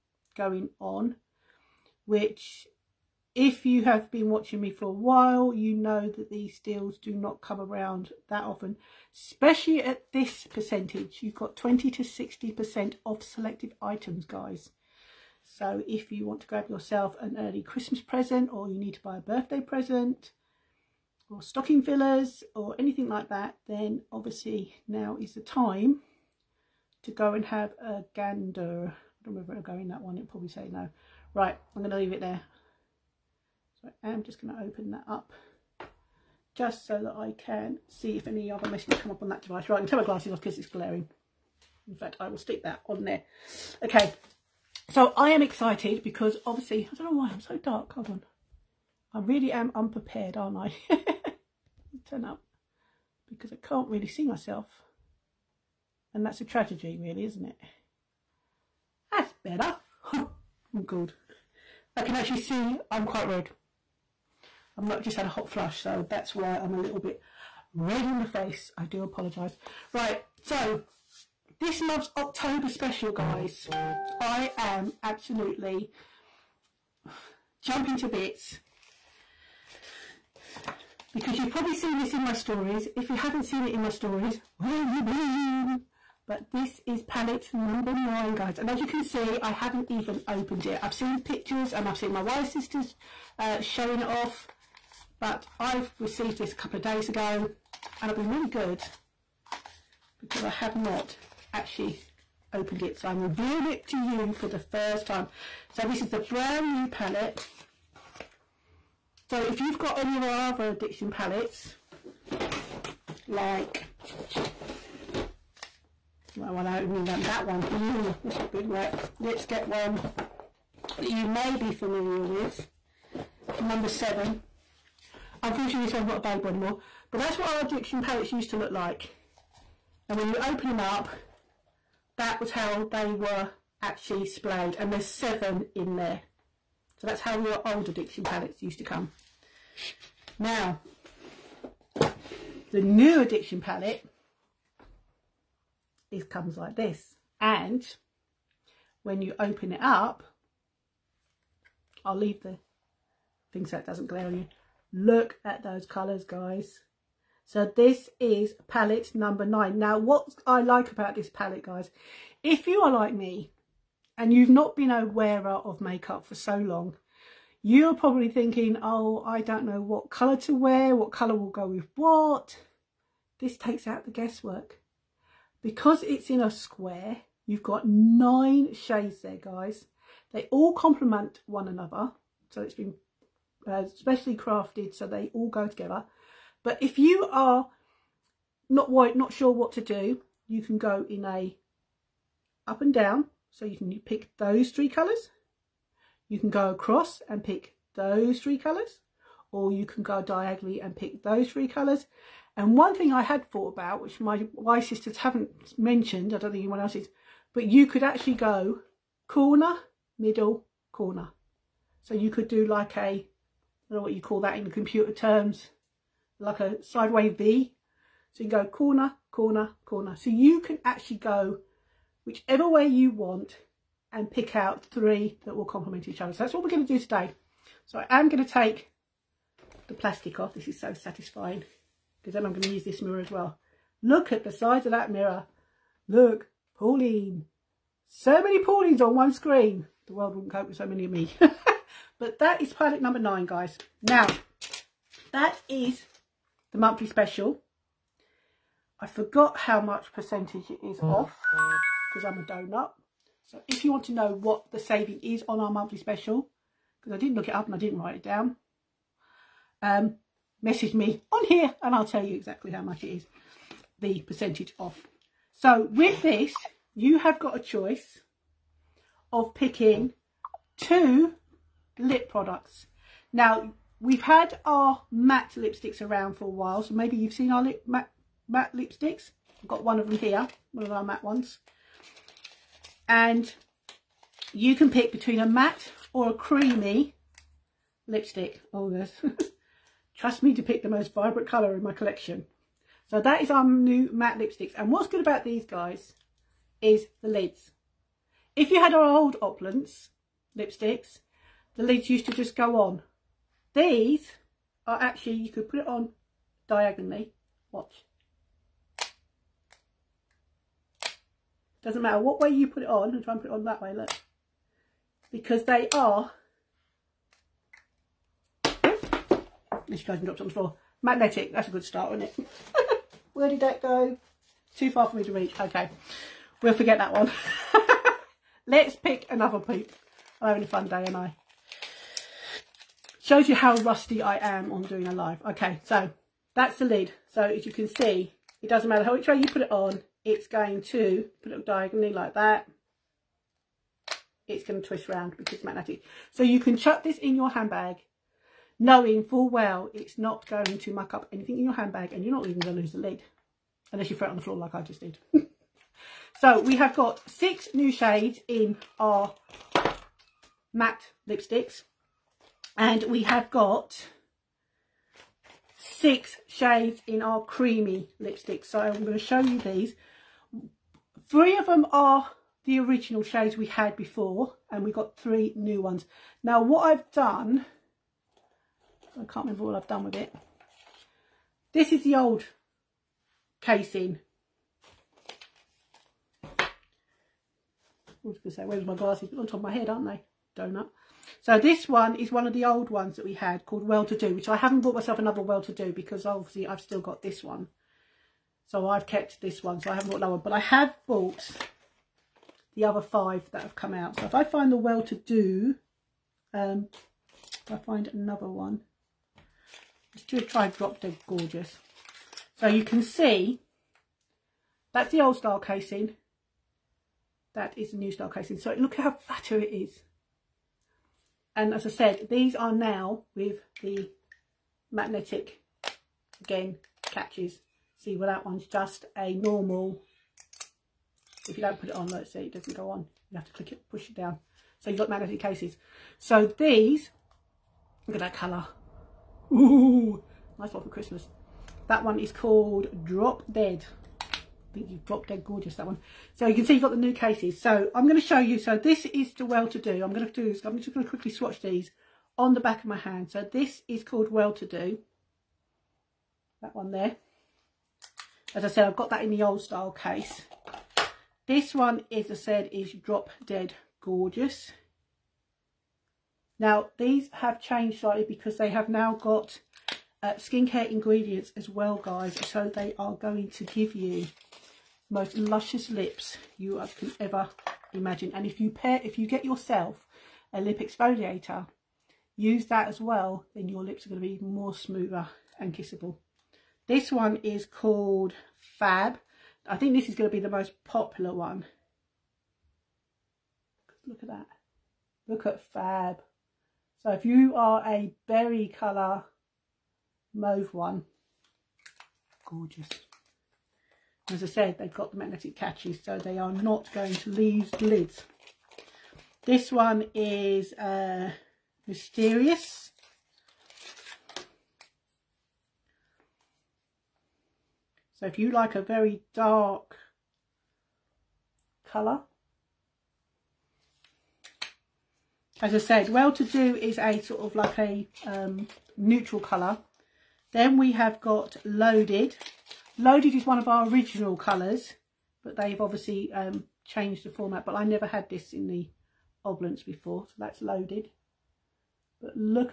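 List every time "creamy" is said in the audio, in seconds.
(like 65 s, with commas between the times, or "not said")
286 s, 367 s.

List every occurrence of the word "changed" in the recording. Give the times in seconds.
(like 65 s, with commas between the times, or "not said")
467 s, 536 s.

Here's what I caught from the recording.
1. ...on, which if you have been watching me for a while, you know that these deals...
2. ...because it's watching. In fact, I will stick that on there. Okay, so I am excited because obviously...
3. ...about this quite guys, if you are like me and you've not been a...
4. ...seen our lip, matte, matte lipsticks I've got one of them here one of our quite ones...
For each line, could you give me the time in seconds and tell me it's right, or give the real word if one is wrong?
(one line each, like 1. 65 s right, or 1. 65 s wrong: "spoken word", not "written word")
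1. 0 s right
2. 40 s wrong: "glaring", not "watching"
3. 160 s wrong: "palette", not "quite"
4. 277 s wrong: "matte", not "quite".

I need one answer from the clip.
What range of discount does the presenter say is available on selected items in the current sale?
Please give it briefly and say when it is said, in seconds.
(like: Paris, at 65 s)
20 to 60%, at 11 s.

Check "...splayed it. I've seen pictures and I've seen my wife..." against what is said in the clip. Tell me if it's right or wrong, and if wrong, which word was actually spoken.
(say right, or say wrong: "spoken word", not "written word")
wrong: "opened", not "splayed".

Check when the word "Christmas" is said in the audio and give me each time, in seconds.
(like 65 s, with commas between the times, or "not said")
17 s, 440 s.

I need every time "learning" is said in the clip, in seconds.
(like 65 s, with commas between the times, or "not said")
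not said.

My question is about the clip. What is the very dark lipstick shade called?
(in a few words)
Mysterious.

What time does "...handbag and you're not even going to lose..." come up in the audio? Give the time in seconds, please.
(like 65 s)
351 s.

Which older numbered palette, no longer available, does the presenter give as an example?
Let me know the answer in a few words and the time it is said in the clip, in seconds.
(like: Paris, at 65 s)
7, at 123 s.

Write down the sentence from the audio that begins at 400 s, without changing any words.
But I have bought the other five that have come out.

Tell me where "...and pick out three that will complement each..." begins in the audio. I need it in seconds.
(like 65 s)
224 s.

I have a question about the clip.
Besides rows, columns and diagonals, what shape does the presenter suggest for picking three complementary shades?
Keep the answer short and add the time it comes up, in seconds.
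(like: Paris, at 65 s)
sideways V, at 216 s.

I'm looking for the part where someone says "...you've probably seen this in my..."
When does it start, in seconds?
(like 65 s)
81 s.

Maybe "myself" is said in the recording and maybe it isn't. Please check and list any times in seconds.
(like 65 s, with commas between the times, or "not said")
54 s, 394 s.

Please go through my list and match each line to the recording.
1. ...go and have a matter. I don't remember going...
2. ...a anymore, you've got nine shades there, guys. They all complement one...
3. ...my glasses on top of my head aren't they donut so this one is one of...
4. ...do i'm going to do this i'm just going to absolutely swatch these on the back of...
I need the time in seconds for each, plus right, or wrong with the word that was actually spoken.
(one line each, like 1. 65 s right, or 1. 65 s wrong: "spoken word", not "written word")
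1. 27 s wrong: "gander", not "matter"
2. 176 s wrong: "square", not "anymore"
3. 388 s right
4. 449 s wrong: "quickly", not "absolutely".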